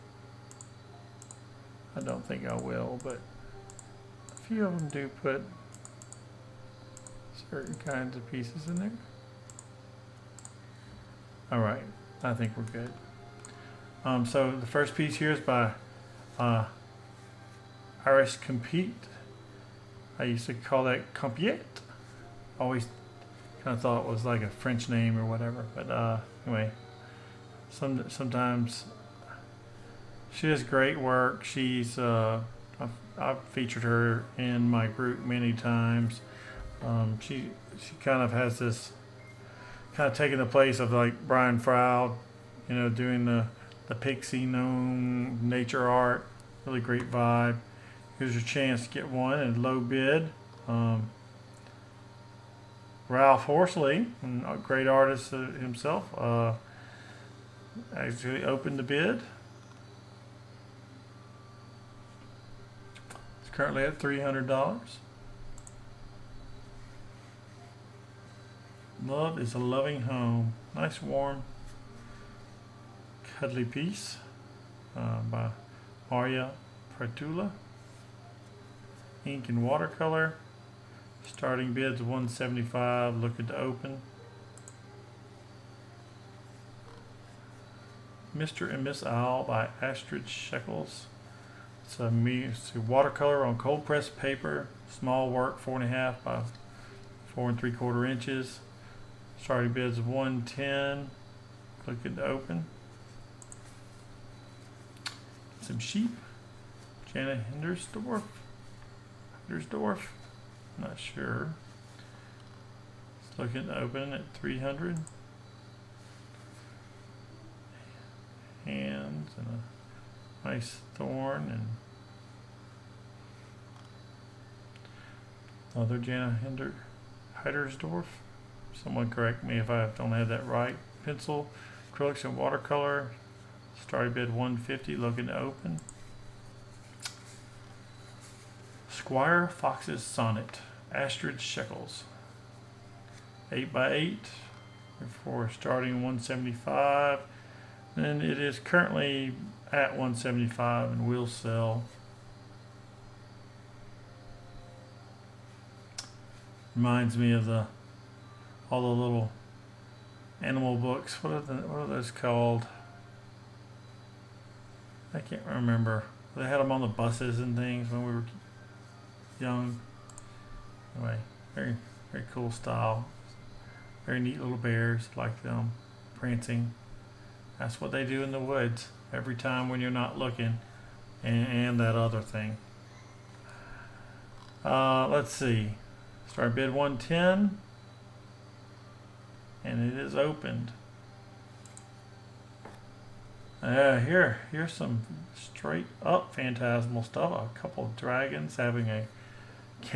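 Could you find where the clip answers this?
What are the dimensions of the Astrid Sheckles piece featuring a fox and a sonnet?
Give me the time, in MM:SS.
02:23.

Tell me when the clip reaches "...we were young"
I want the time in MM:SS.
02:48.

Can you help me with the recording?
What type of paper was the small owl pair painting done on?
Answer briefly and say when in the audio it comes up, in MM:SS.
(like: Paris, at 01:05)
cold pressed paper, at 01:33.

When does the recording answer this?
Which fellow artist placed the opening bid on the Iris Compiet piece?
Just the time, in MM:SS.
00:53.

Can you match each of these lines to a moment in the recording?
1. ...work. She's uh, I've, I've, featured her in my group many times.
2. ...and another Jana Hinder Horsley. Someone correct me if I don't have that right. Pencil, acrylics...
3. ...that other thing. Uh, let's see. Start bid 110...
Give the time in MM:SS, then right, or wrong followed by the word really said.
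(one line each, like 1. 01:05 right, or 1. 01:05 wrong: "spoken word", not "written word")
1. 00:30 right
2. 02:01 wrong: "Heidersdorf", not "Horsley"
3. 03:01 right.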